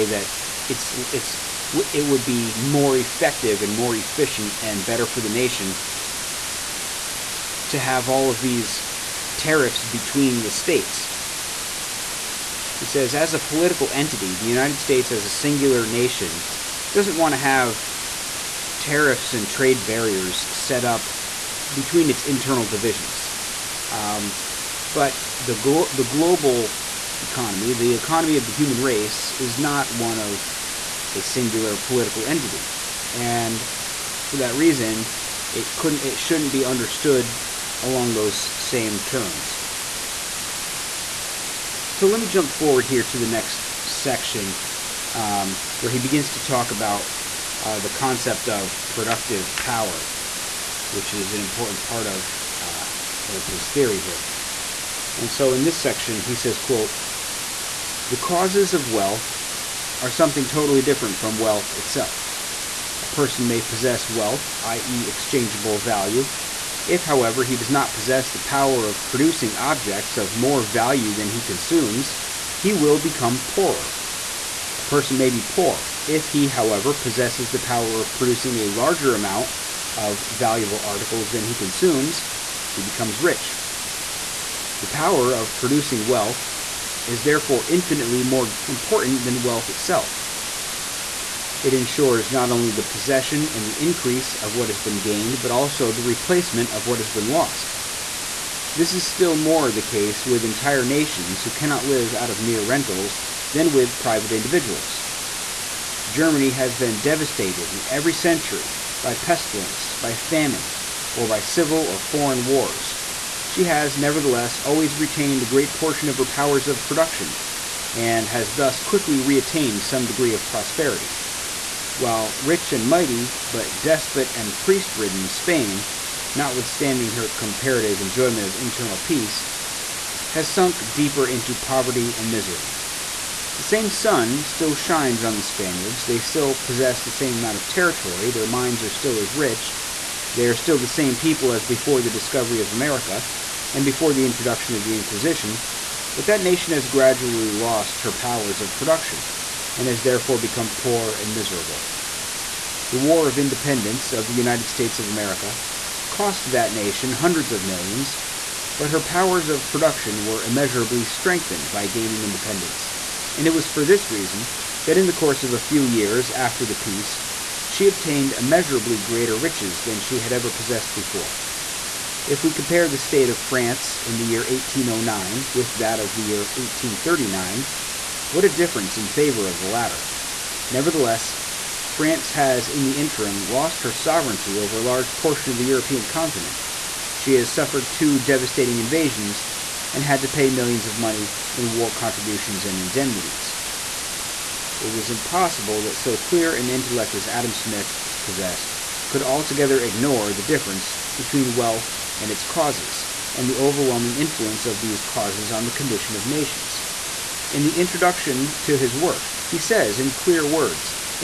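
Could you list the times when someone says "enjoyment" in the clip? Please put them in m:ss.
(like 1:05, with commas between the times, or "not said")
2:08.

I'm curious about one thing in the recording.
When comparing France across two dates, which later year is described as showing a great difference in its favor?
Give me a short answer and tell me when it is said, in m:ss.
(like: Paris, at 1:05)
1839, at 2:56.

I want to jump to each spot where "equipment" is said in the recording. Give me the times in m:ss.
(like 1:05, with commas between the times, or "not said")
not said.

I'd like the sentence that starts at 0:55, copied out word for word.
And so in this section, he says, quote, the causes of wealth are something totally different from wealth itself.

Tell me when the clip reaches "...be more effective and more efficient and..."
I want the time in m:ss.
0:02.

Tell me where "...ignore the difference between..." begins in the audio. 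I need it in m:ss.
3:19.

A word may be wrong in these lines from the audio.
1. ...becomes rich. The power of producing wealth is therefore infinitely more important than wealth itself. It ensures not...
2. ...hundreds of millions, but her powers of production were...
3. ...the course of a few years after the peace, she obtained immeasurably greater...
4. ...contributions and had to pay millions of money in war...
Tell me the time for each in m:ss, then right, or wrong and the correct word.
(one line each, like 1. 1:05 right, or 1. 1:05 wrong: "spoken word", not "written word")
1. 1:22 right
2. 2:37 right
3. 2:45 right
4. 3:08 wrong: "invasions", not "contributions".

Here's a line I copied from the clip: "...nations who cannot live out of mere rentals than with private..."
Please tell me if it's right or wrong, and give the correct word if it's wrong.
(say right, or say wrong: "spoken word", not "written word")
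right.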